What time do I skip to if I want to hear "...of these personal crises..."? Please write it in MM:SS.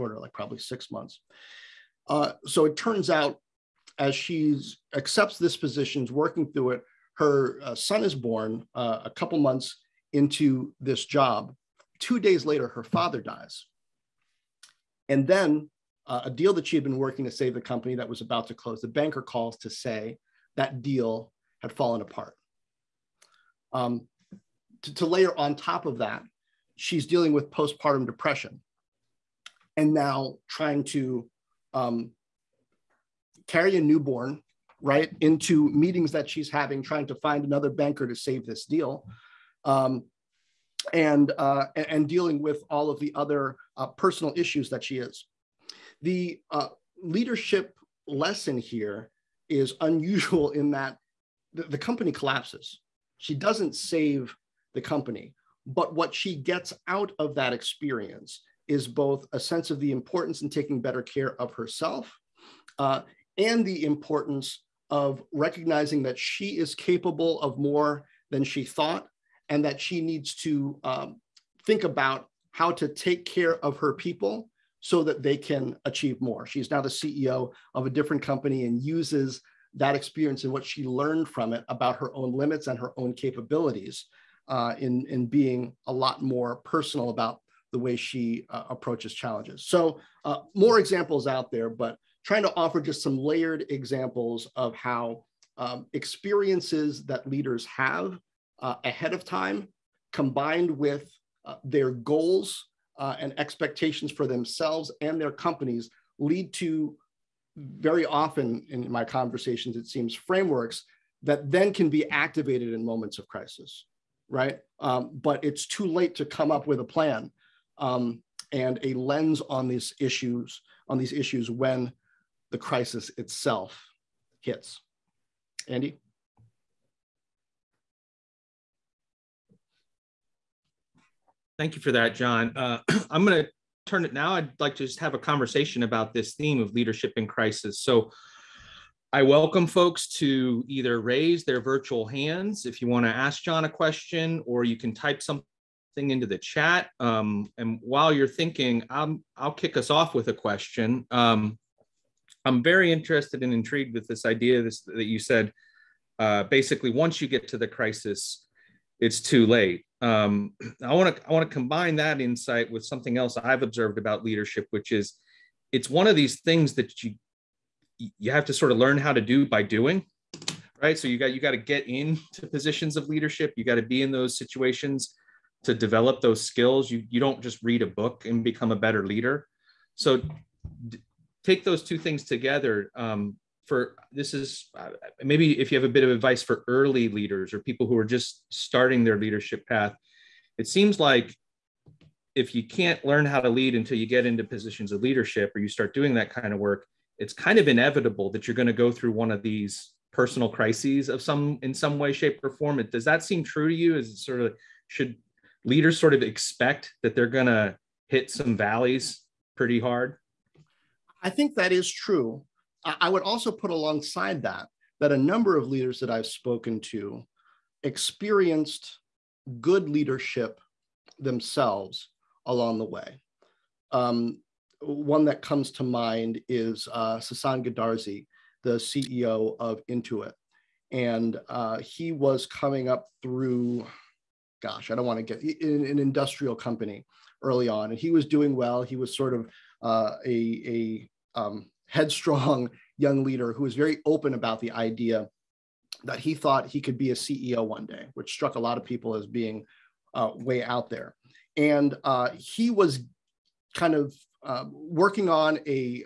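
03:19.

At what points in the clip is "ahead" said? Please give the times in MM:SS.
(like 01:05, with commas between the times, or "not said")
01:38.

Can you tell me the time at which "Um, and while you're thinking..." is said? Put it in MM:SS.
02:26.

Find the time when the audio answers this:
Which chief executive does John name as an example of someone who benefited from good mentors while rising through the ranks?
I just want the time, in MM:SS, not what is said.
03:47.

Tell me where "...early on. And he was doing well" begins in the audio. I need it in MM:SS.
03:57.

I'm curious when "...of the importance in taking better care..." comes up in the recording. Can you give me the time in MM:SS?
00:59.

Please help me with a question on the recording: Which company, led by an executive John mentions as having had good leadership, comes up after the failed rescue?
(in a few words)
Intuit.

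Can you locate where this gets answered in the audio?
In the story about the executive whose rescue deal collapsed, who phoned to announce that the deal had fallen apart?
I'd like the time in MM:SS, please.
00:18.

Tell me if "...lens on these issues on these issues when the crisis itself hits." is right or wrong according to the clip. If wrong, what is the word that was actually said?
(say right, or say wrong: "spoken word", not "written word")
right.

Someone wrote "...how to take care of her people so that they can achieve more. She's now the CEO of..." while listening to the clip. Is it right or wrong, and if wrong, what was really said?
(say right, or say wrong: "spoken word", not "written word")
right.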